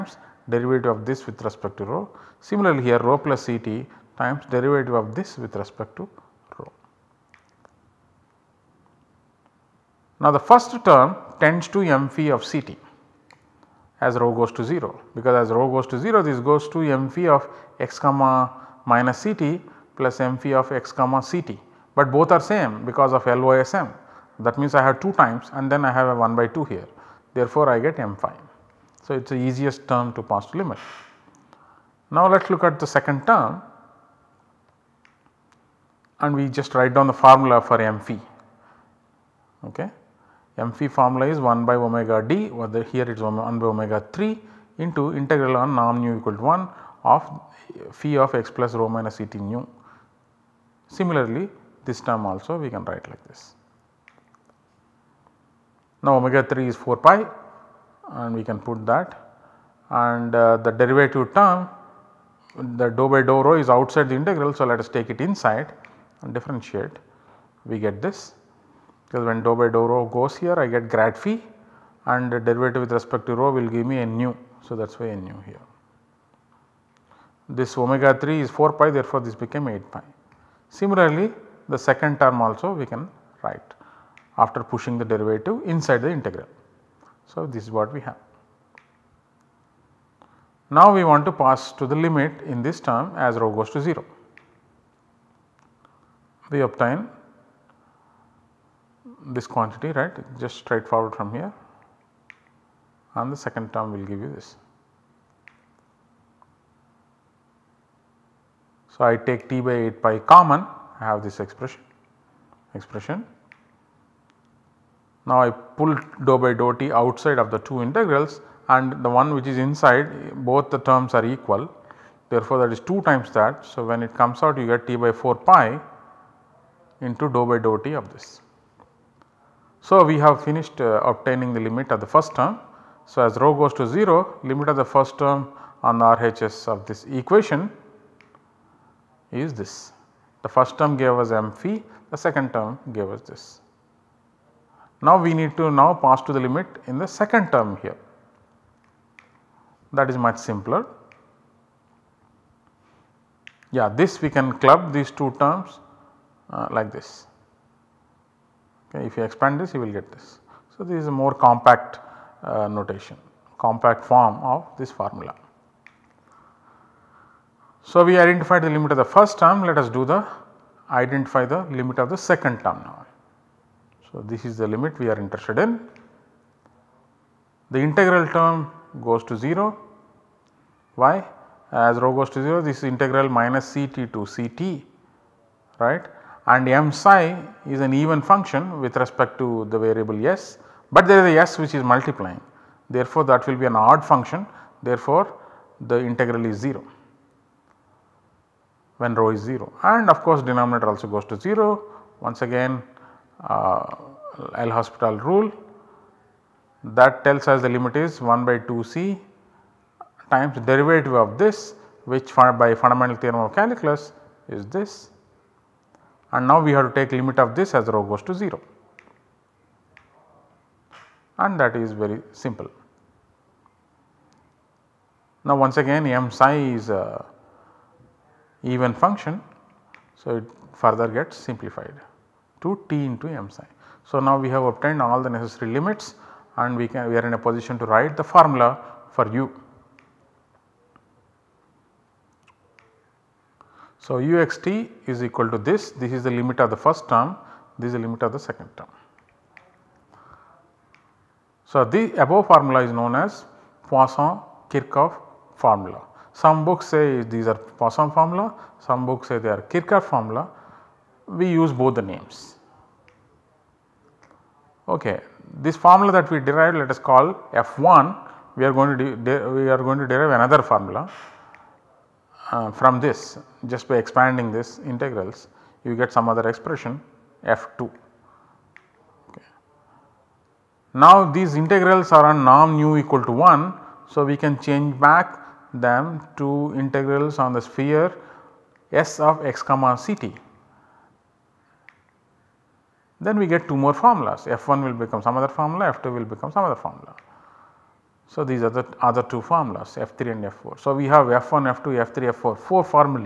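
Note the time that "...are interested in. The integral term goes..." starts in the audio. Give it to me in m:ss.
2:55.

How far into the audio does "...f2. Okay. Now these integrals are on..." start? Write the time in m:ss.
4:37.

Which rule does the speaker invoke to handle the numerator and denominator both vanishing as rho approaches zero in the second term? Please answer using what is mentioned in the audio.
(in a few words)
L'Hospital rule.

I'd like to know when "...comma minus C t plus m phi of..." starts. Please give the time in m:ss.
0:17.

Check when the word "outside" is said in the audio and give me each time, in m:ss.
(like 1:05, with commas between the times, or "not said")
1:03, 1:56.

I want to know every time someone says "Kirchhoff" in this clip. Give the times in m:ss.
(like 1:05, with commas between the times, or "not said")
4:14, 4:19.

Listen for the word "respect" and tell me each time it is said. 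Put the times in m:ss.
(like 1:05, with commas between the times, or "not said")
0:01, 0:05, 1:12, 3:08.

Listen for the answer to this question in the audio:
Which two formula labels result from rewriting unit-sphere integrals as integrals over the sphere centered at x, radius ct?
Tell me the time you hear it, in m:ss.
4:59.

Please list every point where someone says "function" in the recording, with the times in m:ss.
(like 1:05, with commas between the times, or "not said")
3:08, 3:14, 3:48.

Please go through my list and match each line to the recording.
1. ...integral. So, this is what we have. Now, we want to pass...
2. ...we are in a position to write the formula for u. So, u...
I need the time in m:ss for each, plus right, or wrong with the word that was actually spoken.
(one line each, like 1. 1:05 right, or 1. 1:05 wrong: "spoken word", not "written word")
1. 1:26 right
2. 3:57 right.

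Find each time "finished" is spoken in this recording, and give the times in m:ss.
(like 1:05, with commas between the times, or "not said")
2:10.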